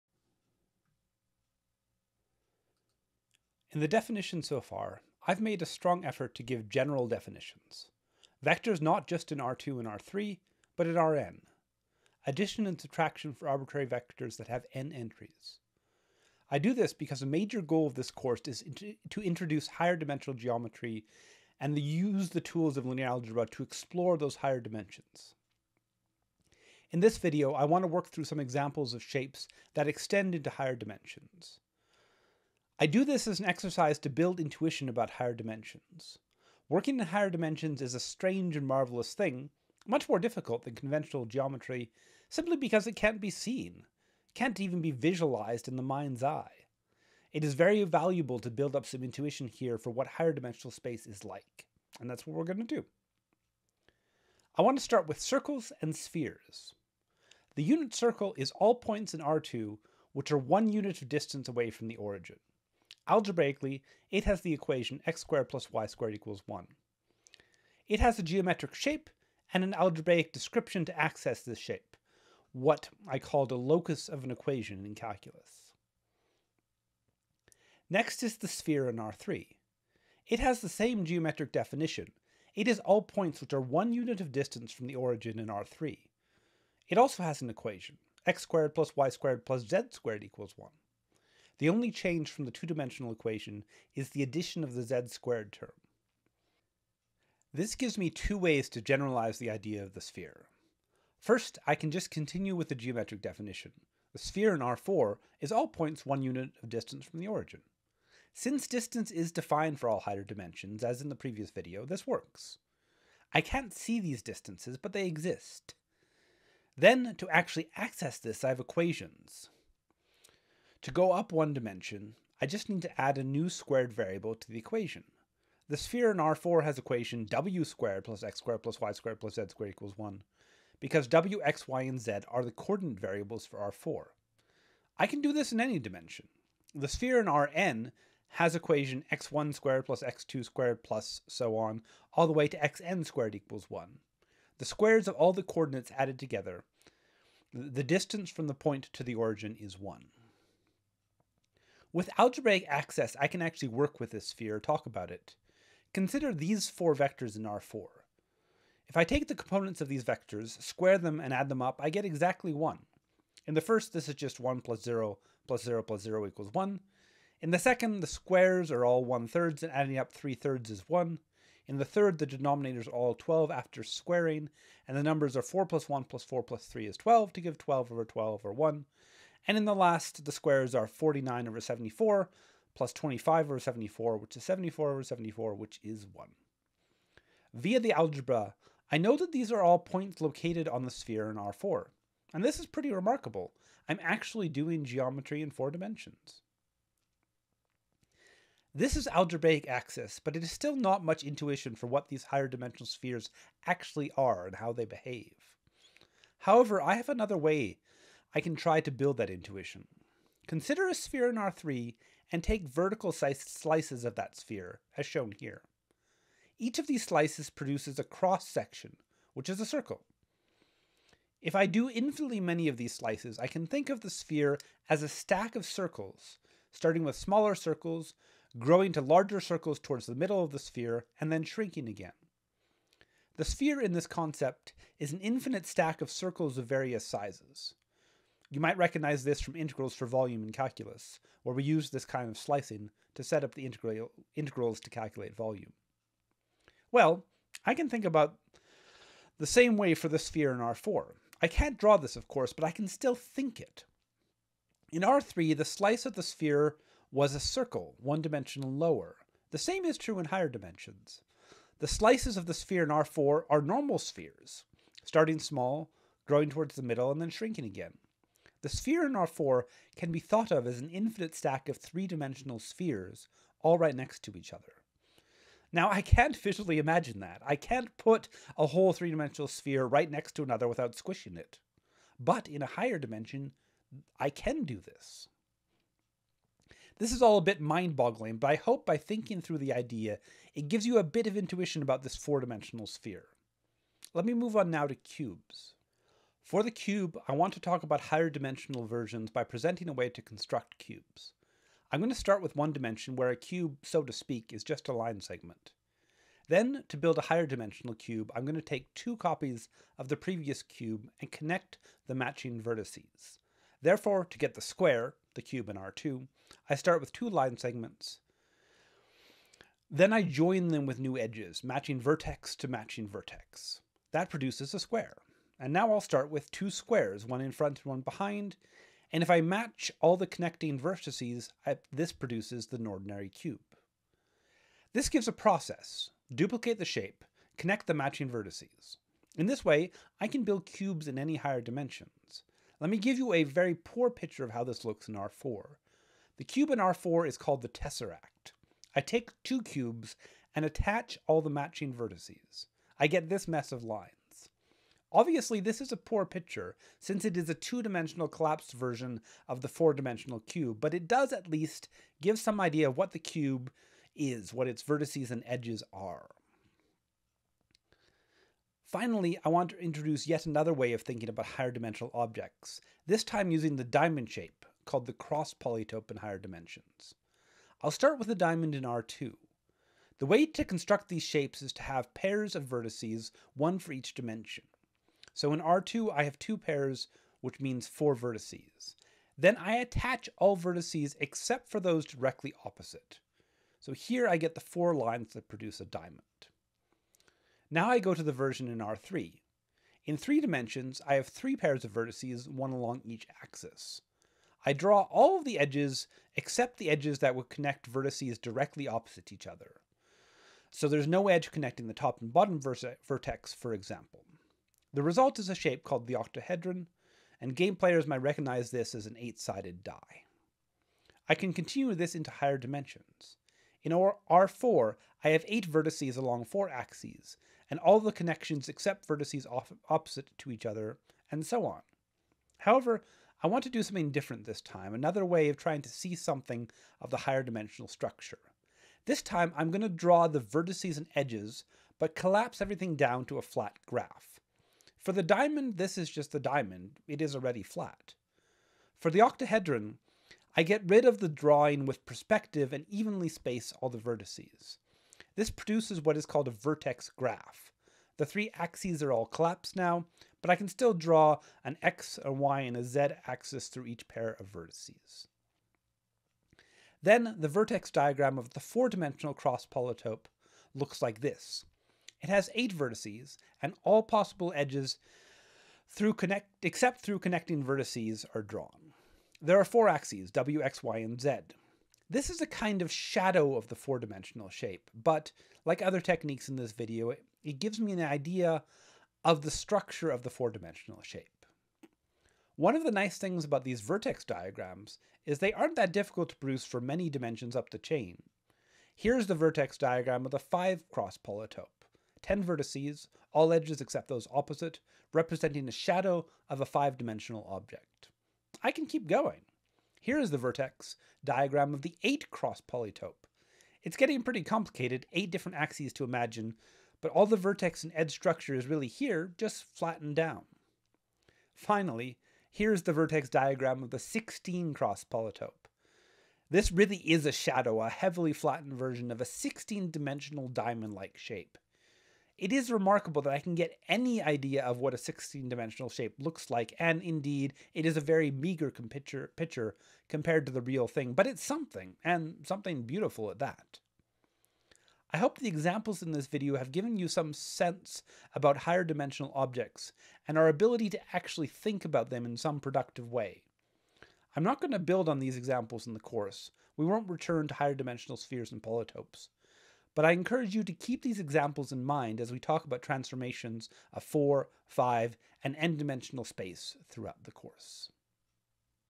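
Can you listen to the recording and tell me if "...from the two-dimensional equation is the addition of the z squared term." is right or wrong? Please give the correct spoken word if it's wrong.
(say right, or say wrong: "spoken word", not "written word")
right.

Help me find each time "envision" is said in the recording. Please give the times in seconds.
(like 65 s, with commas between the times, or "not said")
not said.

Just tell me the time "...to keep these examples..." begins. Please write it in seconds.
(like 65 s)
560 s.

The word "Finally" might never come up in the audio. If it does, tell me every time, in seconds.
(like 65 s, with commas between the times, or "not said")
368 s, 521 s.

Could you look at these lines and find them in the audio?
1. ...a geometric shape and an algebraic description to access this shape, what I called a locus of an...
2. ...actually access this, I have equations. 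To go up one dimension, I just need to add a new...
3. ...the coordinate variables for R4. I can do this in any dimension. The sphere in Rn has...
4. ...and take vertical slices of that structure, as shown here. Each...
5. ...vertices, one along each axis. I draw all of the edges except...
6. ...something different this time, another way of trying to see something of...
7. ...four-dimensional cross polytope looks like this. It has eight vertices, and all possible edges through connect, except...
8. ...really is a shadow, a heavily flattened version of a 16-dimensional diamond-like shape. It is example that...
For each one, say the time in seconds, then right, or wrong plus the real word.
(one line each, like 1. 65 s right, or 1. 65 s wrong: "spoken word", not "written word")
1. 68 s right
2. 117 s right
3. 132 s right
4. 212 s wrong: "sphere", not "structure"
5. 401 s right
6. 433 s right
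7. 468 s right
8. 526 s wrong: "remarkable", not "example".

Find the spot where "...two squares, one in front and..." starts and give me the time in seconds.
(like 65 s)
326 s.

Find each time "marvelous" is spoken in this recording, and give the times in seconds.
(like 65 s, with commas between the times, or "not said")
38 s.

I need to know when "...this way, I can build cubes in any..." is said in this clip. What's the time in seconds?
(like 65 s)
339 s.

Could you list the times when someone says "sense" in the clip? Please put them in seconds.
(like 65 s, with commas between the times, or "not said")
547 s.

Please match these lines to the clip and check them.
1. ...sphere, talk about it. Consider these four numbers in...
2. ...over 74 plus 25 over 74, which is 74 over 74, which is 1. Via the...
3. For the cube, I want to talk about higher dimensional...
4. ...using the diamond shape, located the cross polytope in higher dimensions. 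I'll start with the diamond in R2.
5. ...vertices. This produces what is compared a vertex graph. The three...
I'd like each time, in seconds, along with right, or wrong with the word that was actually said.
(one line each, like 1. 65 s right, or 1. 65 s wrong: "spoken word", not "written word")
1. 154 s wrong: "vectors", not "numbers"
2. 181 s right
3. 296 s right
4. 373 s wrong: "called", not "located"
5. 453 s wrong: "called", not "compared".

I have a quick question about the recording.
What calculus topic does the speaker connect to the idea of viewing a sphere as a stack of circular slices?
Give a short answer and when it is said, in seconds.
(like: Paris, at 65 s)
integrals for volume, at 239 s.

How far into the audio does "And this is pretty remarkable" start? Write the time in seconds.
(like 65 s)
192 s.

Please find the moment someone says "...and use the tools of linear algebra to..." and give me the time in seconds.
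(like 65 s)
21 s.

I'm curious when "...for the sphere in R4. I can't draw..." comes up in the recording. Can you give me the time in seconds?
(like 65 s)
249 s.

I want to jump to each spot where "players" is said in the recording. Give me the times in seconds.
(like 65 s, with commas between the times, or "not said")
417 s.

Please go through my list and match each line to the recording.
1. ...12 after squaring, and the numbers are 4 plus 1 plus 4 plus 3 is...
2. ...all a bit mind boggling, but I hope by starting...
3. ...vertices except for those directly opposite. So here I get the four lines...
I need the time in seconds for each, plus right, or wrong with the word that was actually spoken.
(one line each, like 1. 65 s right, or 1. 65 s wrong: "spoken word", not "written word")
1. 173 s right
2. 287 s wrong: "thinking", not "starting"
3. 390 s right.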